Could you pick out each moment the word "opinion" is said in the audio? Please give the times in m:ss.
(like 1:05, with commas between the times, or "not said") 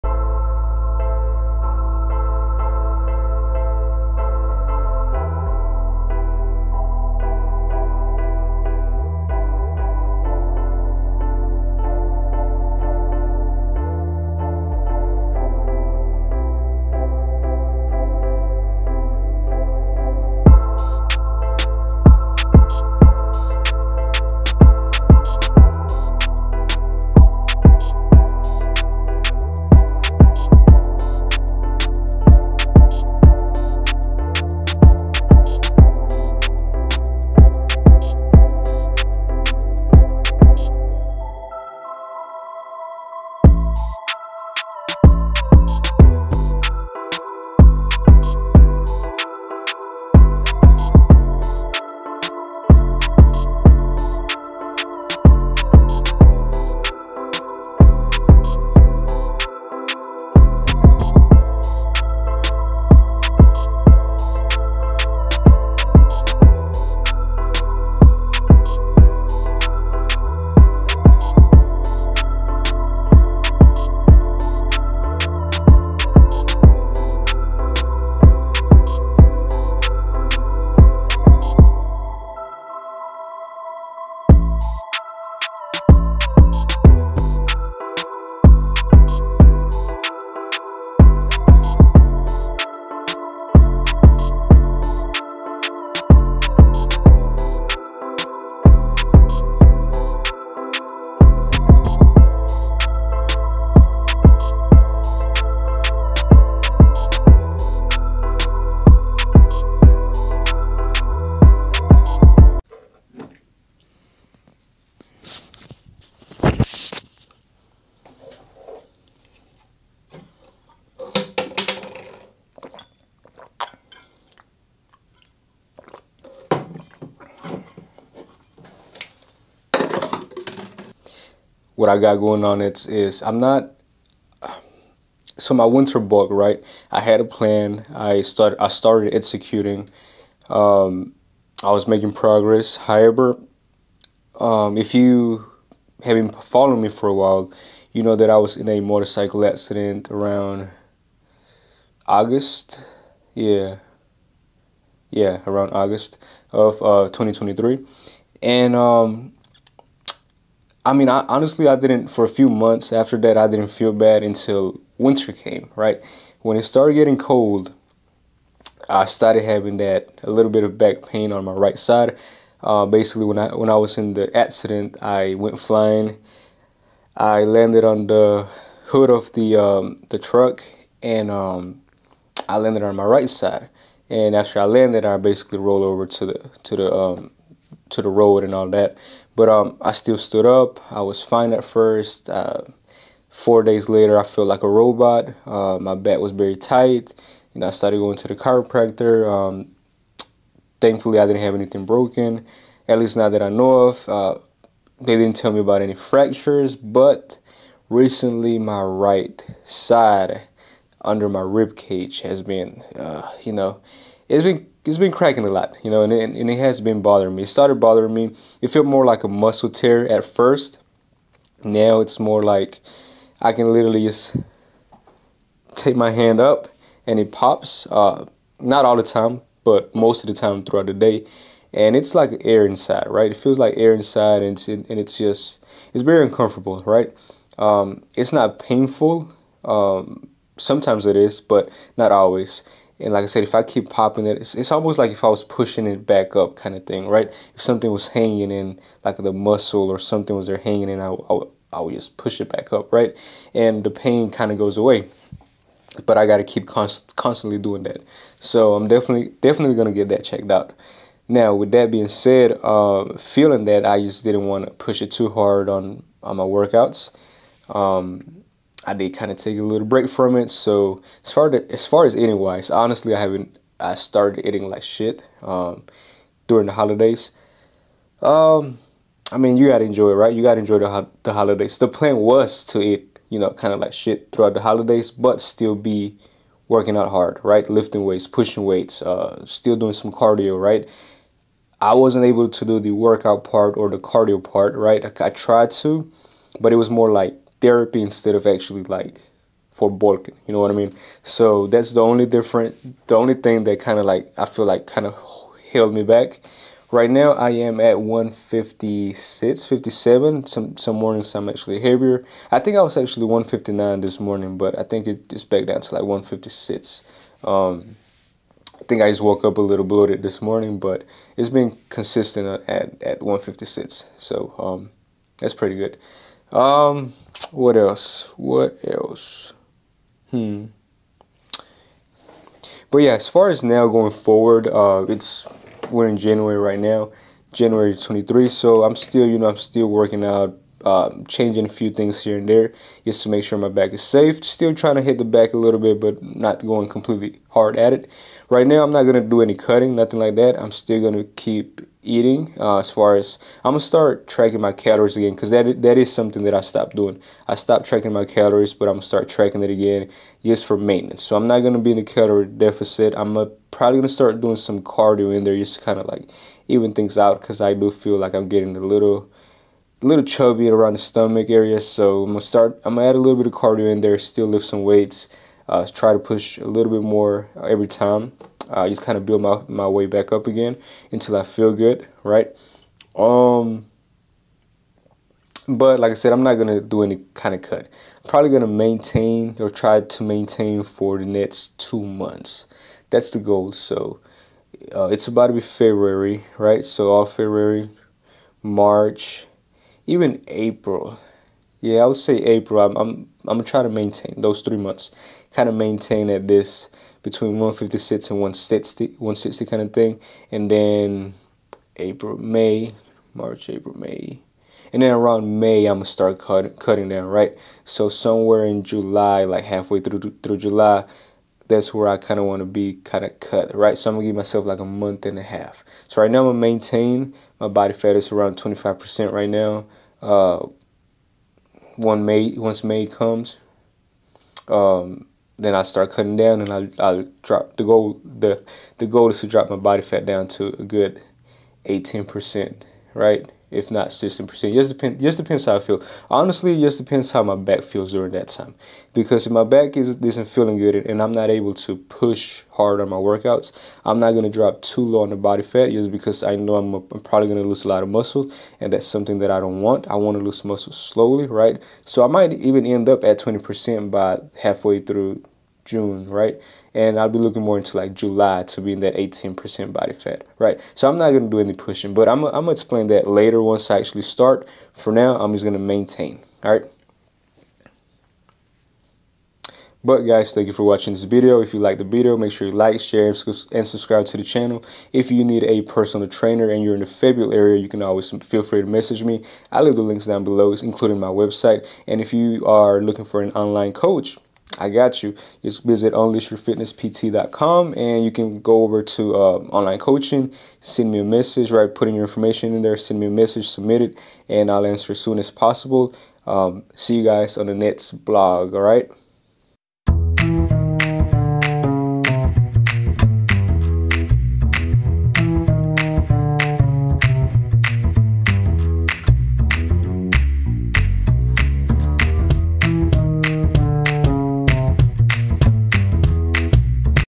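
not said.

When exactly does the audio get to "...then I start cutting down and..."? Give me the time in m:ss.
7:15.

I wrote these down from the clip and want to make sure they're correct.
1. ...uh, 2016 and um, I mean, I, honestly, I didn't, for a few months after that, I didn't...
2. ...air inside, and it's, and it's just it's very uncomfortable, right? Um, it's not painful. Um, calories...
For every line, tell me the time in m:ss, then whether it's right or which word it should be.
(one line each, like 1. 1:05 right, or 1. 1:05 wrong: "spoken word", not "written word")
1. 2:36 wrong: "2023", not "2016"
2. 3:53 wrong: "sometimes", not "calories".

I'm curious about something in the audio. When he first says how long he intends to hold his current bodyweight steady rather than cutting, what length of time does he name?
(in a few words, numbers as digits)
2 months.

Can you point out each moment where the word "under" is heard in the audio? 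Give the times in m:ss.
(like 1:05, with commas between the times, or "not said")
3:31.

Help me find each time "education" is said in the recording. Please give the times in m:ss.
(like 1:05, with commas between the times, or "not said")
not said.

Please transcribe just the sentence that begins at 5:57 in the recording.
I stopped tracking my calories, but I'm gonna start tracking it again just for maintenance.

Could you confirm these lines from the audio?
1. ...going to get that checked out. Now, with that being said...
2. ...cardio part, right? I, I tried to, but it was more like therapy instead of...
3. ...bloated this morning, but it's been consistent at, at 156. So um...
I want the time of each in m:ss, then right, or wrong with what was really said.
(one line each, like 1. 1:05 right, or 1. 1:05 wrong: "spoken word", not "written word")
1. 4:19 right
2. 4:53 right
3. 5:19 right.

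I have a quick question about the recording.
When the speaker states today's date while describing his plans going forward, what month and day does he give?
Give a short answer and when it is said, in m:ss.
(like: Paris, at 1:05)
January 23, at 5:37.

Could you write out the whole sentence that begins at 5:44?
Still trying to hit the back a little bit, but not going completely hard at it.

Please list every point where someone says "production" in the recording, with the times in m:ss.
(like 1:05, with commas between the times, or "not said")
not said.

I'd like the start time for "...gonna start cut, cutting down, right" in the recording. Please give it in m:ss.
6:55.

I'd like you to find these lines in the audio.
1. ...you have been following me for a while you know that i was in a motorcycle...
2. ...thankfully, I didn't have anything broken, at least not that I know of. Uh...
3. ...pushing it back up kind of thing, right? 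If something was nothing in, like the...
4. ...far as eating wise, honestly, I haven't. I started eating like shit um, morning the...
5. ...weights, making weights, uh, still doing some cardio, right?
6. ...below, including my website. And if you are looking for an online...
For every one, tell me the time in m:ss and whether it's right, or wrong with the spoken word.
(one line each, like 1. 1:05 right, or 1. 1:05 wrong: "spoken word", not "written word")
1. 2:24 right
2. 3:20 right
3. 4:05 wrong: "hanging", not "nothing"
4. 4:31 wrong: "during", not "morning"
5. 4:48 wrong: "pushing", not "making"
6. 8:10 right.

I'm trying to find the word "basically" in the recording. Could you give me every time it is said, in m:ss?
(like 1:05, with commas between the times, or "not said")
2:52, 3:05.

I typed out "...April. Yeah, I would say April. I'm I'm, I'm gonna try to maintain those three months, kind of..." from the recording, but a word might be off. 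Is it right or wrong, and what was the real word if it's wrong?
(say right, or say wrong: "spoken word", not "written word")
right.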